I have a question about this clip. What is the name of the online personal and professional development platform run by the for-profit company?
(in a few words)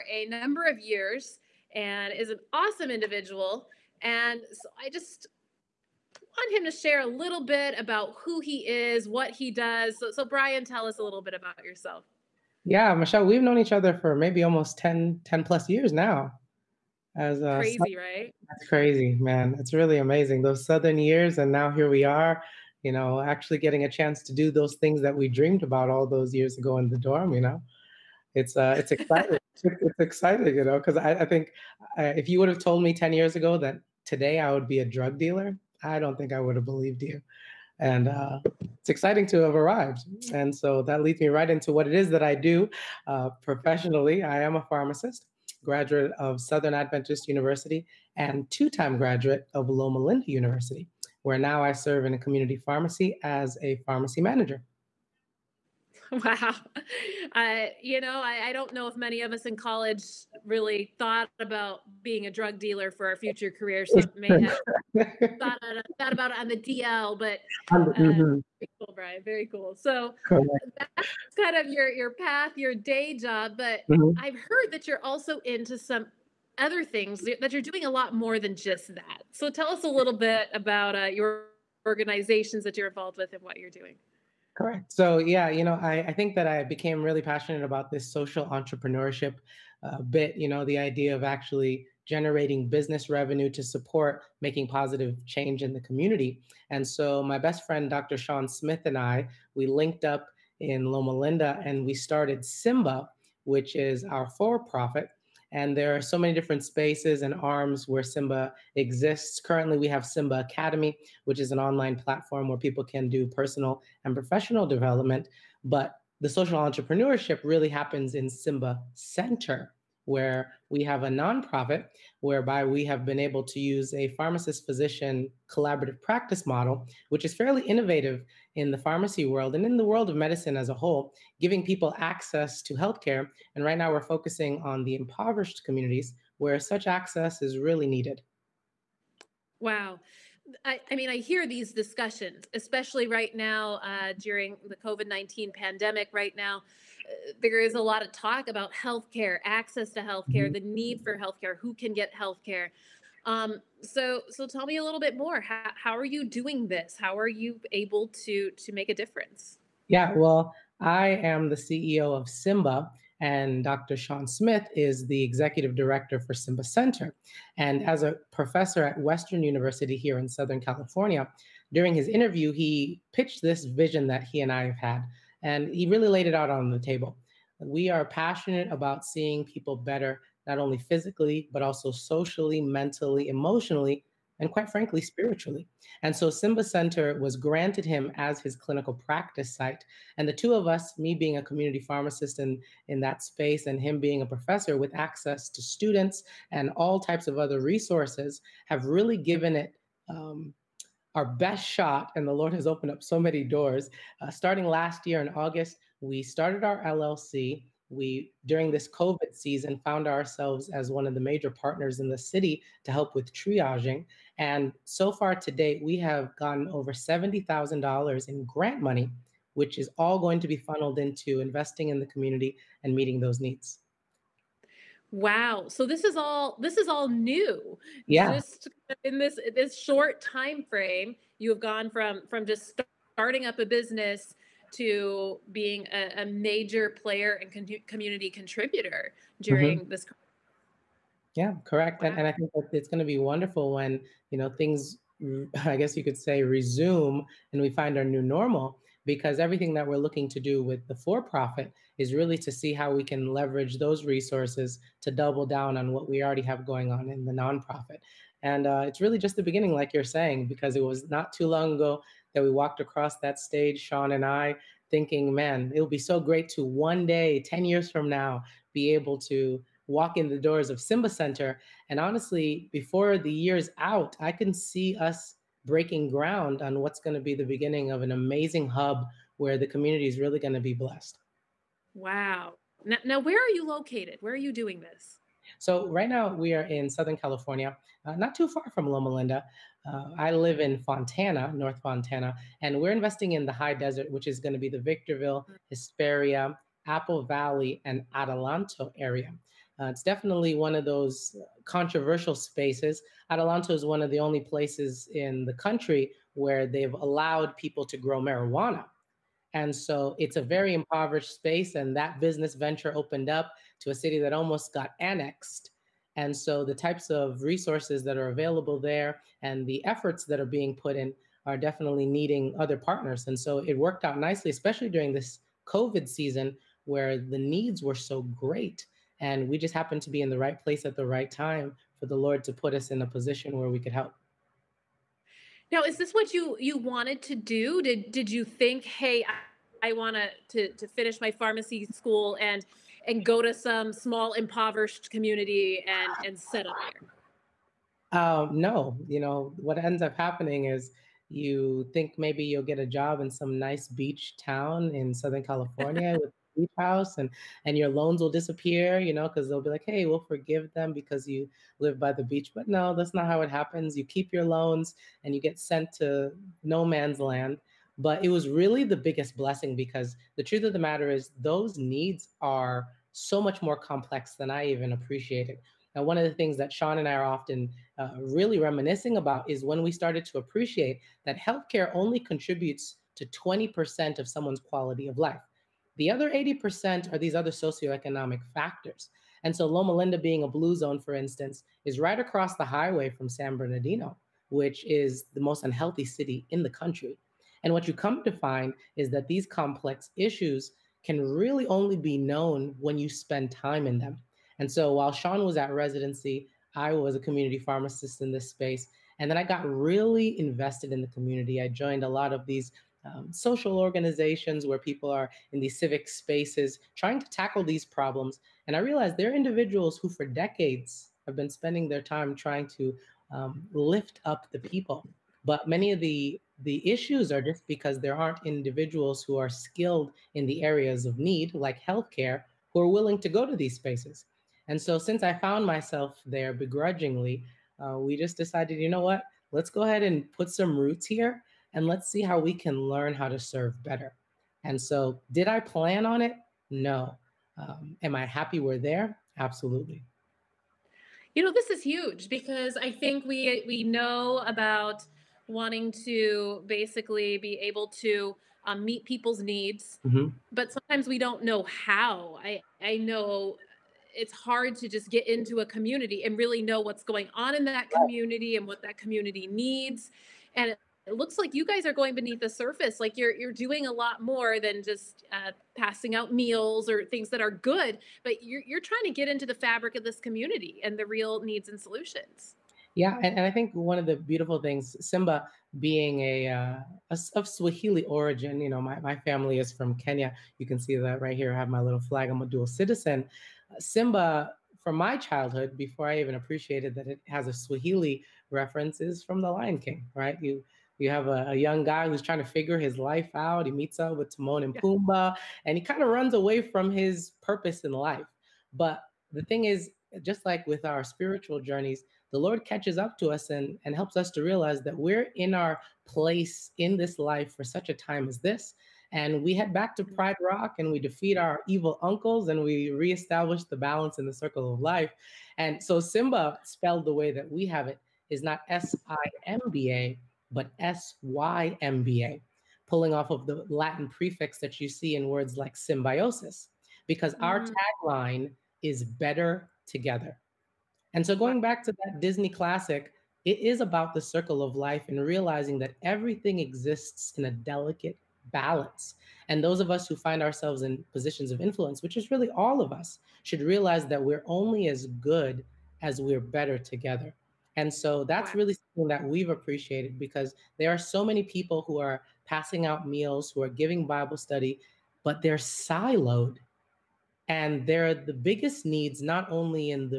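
Symba Academy.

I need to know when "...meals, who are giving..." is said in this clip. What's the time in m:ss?
9:23.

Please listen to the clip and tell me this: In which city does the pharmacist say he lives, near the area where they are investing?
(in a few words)
North Fontana.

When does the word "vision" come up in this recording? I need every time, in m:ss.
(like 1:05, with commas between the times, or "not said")
2:53.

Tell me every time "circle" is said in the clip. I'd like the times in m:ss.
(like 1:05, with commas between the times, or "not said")
8:44, 9:04.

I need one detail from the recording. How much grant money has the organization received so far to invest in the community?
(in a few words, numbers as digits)
$70,000.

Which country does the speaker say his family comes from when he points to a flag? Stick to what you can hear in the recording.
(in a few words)
Kenya.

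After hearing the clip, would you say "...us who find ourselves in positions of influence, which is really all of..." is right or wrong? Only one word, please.
right.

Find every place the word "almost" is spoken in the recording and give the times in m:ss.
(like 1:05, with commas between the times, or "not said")
0:14, 5:14.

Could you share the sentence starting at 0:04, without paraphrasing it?
And so I just want him to share a little bit about who he is, what he does.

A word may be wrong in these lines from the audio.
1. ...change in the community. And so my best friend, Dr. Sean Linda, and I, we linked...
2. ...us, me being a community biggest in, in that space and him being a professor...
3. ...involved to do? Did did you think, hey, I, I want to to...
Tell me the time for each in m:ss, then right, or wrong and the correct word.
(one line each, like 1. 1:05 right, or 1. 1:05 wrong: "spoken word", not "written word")
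1. 1:35 wrong: "Smith", not "Linda"
2. 3:10 wrong: "pharmacist", not "biggest"
3. 5:36 wrong: "wanted", not "involved".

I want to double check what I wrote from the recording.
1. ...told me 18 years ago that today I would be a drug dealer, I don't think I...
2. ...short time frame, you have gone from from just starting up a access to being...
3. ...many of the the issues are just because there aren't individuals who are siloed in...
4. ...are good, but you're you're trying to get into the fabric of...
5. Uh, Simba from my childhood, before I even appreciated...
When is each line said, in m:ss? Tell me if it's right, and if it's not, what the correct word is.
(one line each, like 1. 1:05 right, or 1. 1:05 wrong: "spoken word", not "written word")
1. 0:32 wrong: "10", not "18"
2. 3:49 wrong: "business", not "access"
3. 7:05 wrong: "skilled", not "siloed"
4. 7:57 right
5. 8:13 right.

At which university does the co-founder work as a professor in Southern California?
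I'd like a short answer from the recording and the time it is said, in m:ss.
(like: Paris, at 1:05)
Western University, at 2:49.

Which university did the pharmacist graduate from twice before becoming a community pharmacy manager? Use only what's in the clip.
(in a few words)
Loma Linda University.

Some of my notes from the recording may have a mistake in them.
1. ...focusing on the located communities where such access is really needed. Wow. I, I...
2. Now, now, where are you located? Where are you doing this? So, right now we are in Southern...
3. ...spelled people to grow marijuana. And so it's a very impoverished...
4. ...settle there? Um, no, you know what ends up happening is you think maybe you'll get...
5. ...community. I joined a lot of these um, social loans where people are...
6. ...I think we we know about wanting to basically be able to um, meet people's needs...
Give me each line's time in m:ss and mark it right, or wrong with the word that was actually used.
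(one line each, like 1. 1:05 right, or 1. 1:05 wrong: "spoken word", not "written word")
1. 2:14 wrong: "impoverished", not "located"
2. 4:42 right
3. 5:06 wrong: "allowed", not "spelled"
4. 5:46 right
5. 6:51 wrong: "organizations", not "loans"
6. 7:32 right.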